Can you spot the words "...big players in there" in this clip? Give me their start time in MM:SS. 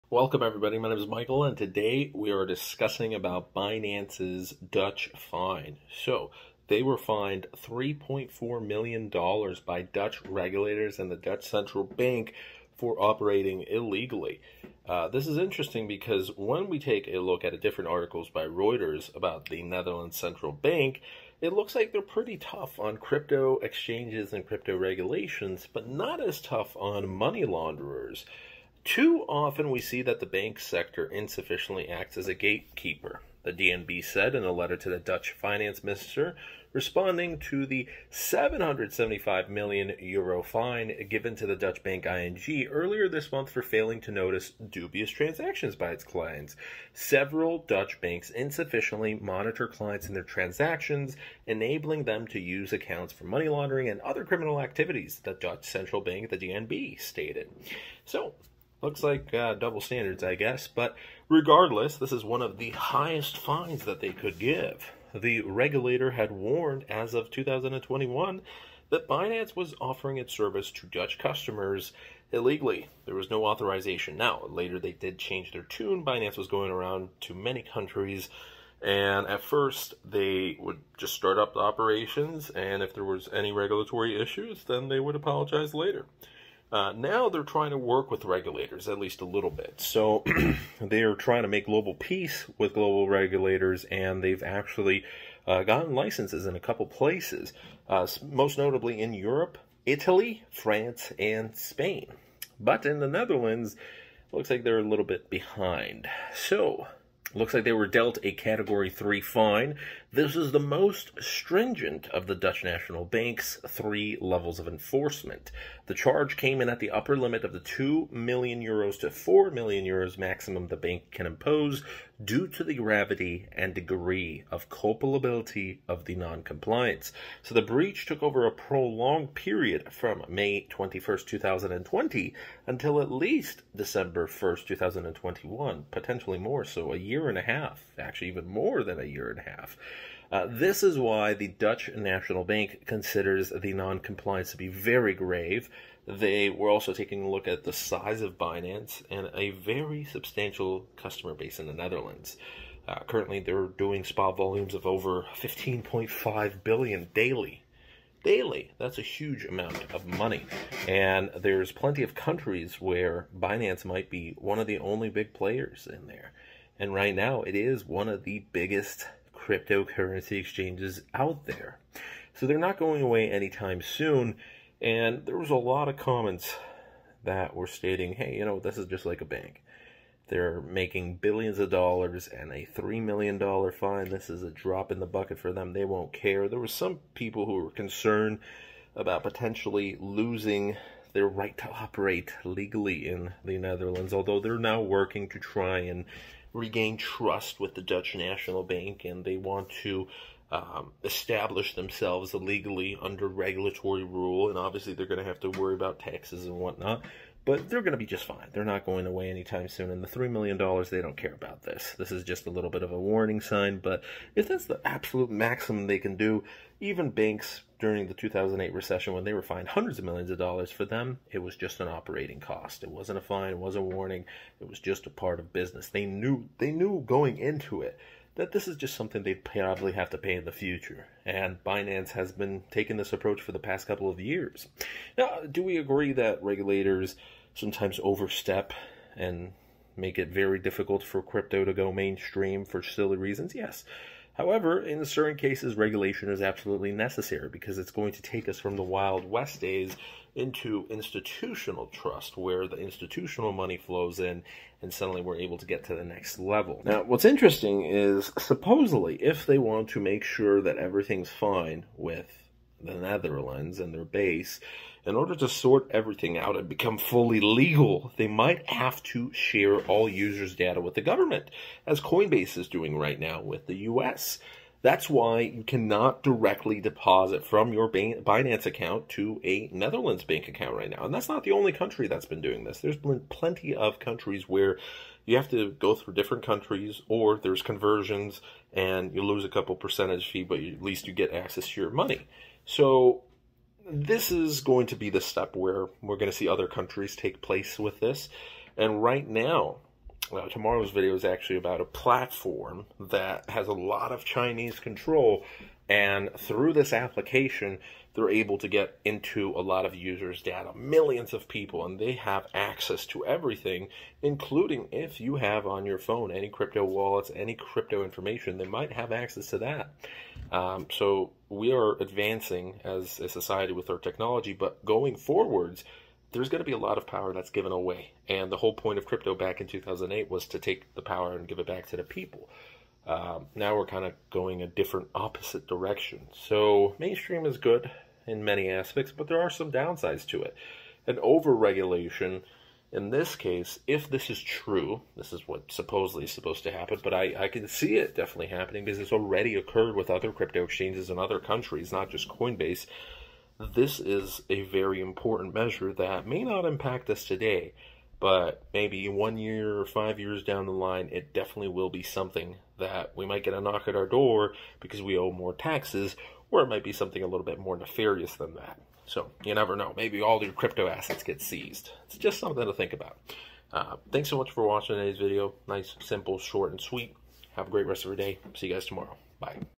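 02:45.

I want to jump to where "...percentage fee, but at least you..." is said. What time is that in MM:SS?
04:49.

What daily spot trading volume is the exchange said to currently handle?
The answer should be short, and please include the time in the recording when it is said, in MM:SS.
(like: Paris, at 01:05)
15.5 billion, at 02:35.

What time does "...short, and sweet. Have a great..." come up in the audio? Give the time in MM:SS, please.
06:16.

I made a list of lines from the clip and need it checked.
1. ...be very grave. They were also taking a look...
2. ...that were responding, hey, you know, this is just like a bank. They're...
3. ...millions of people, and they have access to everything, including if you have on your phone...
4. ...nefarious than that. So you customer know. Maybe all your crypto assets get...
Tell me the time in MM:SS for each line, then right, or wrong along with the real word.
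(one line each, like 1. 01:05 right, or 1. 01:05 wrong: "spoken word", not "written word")
1. 02:24 right
2. 02:57 wrong: "stating", not "responding"
3. 05:10 right
4. 06:07 wrong: "never", not "customer".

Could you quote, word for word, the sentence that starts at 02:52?
So they're not going away anytime soon.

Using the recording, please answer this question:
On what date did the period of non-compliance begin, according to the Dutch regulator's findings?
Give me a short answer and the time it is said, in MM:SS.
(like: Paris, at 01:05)
May 21st, 2020, at 02:10.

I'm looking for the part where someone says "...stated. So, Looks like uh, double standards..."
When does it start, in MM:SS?
00:56.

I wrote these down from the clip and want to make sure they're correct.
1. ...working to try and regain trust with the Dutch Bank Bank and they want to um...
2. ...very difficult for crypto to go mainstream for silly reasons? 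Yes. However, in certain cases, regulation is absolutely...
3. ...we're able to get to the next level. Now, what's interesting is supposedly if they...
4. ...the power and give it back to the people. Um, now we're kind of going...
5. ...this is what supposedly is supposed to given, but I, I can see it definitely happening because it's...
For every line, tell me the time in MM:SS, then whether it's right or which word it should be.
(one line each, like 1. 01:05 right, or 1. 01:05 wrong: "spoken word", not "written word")
1. 03:14 wrong: "National", not "Bank"
2. 04:00 right
3. 04:15 right
4. 05:30 right
5. 05:45 wrong: "happen", not "given".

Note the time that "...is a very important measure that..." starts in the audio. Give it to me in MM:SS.
05:53.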